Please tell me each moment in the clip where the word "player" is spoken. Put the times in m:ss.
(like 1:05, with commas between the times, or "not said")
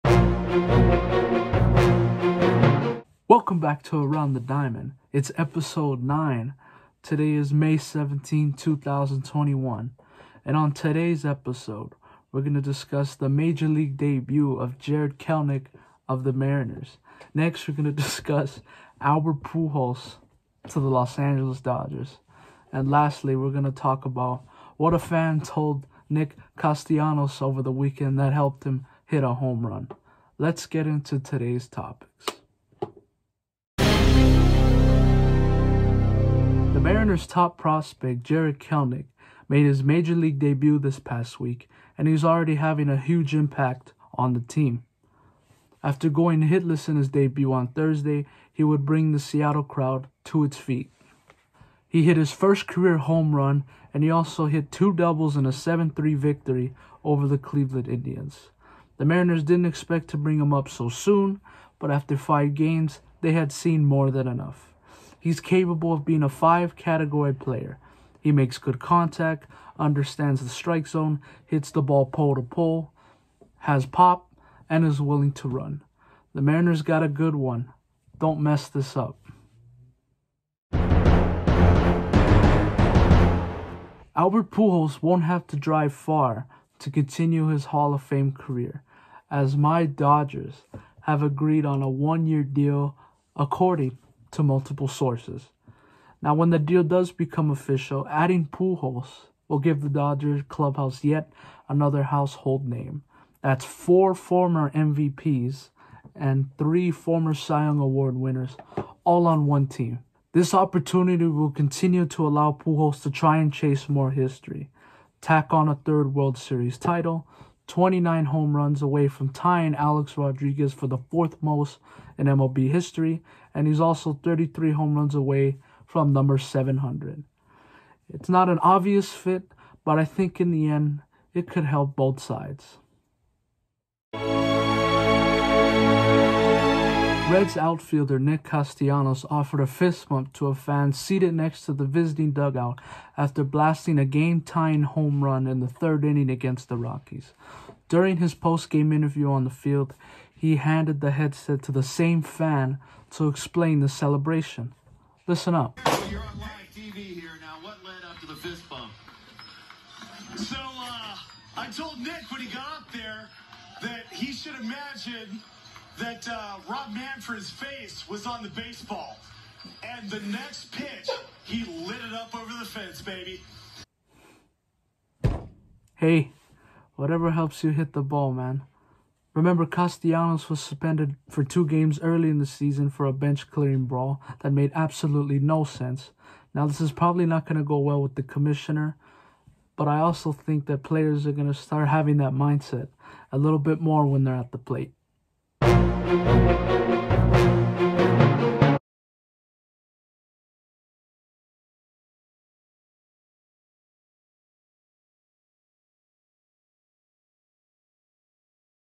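1:07, 3:10.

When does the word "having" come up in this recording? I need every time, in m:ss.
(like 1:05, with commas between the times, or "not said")
0:42, 3:11.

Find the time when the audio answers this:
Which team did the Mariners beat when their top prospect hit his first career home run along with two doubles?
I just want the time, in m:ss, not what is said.
0:57.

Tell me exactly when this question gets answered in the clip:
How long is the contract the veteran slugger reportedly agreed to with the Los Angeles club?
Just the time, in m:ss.
1:31.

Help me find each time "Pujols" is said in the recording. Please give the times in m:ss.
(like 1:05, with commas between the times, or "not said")
0:19, 1:24, 1:38, 1:52.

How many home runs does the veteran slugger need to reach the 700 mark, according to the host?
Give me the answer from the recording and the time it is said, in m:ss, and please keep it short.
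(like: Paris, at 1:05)
33, at 2:04.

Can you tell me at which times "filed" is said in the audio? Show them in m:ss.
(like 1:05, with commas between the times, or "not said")
not said.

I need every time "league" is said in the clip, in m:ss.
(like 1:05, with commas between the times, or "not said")
0:13, 0:40.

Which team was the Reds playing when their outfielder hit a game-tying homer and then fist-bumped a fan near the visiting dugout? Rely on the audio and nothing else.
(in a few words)
Rockies.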